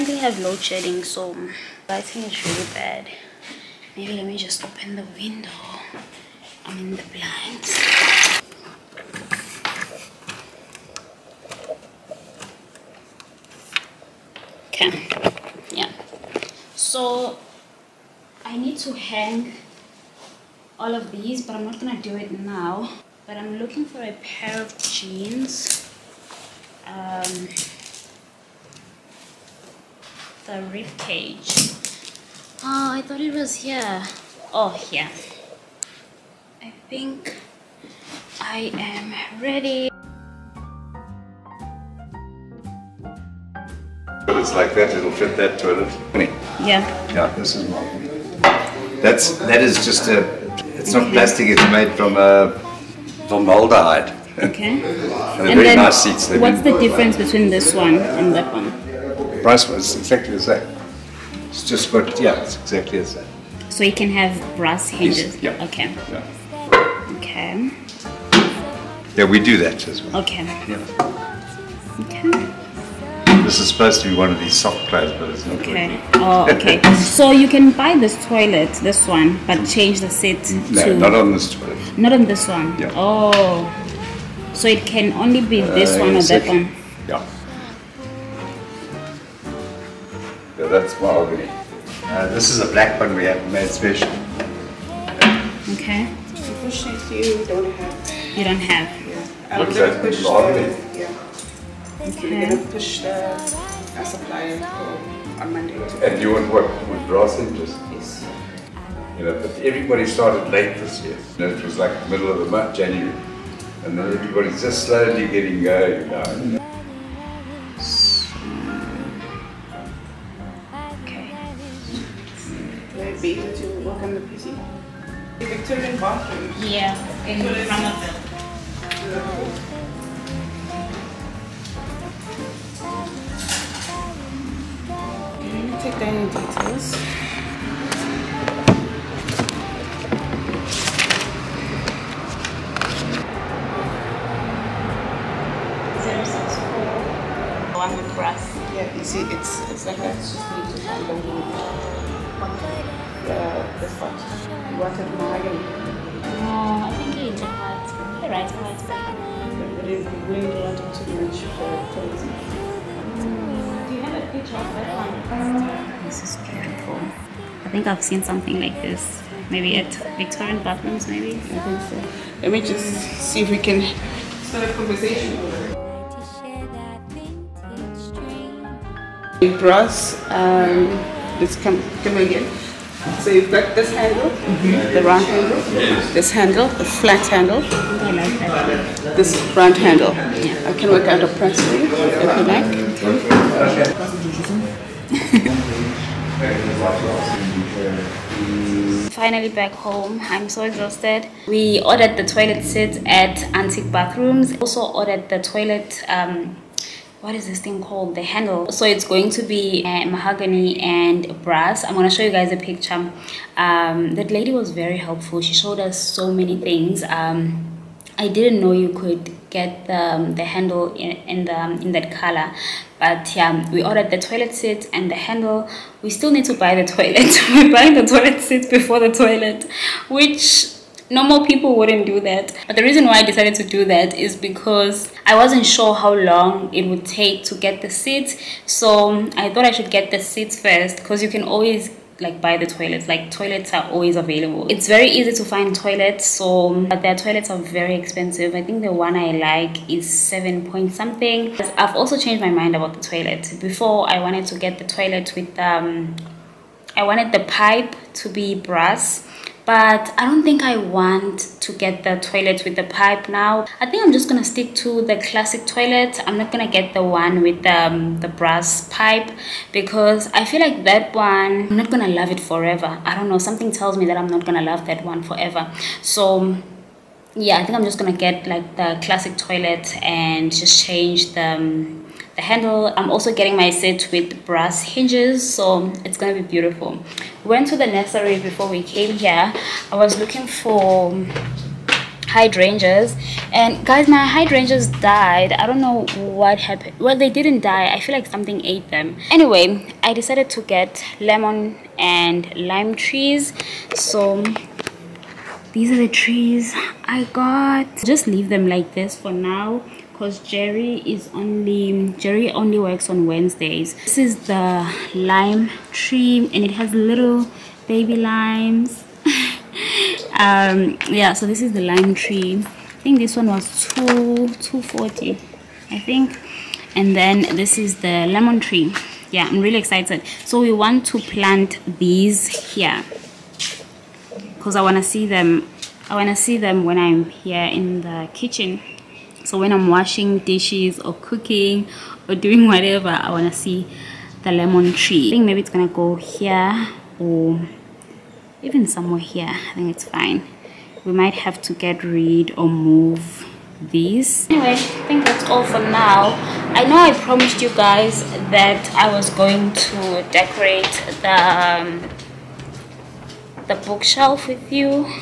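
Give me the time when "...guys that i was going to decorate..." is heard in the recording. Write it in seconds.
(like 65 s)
357 s.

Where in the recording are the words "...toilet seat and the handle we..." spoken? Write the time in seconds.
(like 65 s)
224 s.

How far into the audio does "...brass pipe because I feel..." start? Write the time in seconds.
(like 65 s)
268 s.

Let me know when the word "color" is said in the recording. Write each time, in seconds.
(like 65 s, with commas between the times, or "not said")
222 s.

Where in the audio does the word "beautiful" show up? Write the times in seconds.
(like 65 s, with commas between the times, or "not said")
166 s, 286 s.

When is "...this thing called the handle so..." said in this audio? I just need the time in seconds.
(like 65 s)
207 s.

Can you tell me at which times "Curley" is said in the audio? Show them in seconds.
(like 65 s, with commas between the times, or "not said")
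not said.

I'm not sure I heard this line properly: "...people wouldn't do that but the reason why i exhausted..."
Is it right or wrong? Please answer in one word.
wrong.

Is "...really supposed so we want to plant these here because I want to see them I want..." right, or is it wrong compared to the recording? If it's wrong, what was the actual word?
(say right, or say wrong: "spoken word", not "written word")
wrong: "excited", not "supposed".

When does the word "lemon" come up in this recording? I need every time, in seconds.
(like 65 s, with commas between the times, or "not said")
301 s, 328 s, 344 s.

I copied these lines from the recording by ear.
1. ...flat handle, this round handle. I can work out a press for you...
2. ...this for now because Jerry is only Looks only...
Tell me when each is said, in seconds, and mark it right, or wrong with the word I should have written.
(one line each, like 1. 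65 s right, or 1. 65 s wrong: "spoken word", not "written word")
1. 186 s right
2. 308 s wrong: "Jerry", not "Looks".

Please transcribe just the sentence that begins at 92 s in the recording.
Uh, this is a black one we have made special.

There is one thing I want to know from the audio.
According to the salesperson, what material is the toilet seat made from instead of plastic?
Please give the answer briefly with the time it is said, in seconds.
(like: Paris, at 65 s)
formaldehyde, at 53 s.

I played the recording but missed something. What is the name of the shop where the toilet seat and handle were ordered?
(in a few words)
Antique Bathrooms.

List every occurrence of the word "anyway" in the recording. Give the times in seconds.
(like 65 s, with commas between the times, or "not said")
299 s, 354 s.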